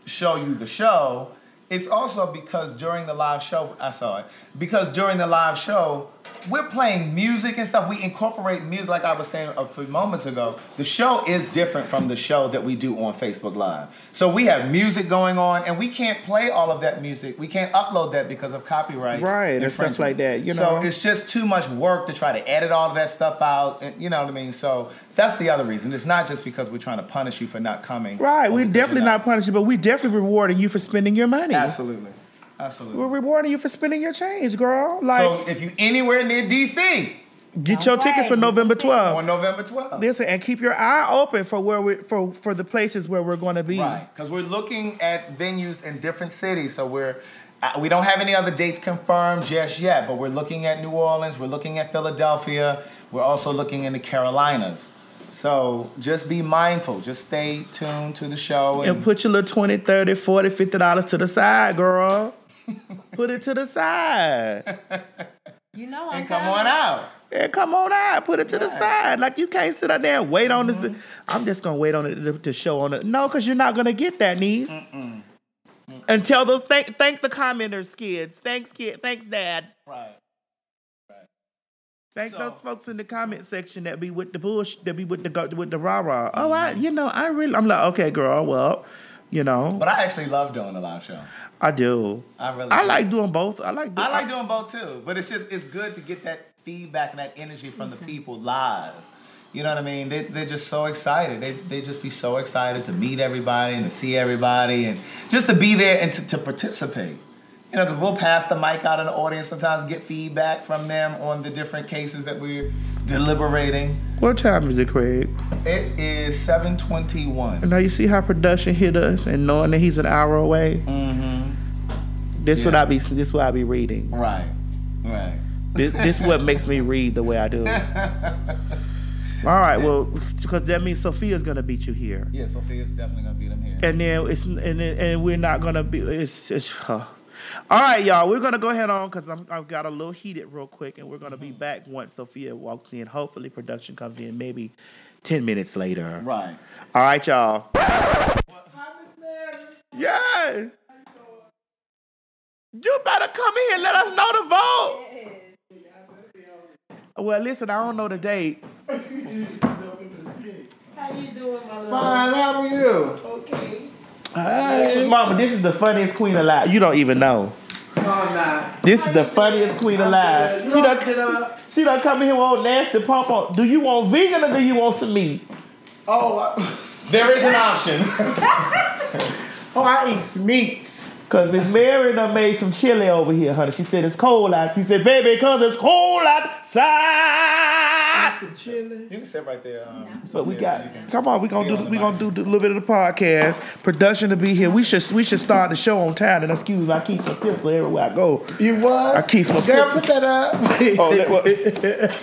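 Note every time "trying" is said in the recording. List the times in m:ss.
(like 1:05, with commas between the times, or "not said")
0:26.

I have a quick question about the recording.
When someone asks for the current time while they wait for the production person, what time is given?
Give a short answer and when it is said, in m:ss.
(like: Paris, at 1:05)
7:21, at 1:56.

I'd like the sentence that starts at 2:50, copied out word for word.
She done, she done come in here with old nasty pump on.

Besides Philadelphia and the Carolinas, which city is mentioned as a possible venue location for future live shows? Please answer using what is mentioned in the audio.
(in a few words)
New Orleans.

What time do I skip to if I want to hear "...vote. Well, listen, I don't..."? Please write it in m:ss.
2:34.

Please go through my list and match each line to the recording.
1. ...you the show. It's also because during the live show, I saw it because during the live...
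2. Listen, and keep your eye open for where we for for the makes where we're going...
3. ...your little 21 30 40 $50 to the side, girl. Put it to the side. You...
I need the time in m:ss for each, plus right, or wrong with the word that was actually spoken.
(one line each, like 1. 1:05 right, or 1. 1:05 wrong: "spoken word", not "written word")
1. 0:00 right
2. 0:39 wrong: "places", not "makes"
3. 0:59 wrong: "20", not "21".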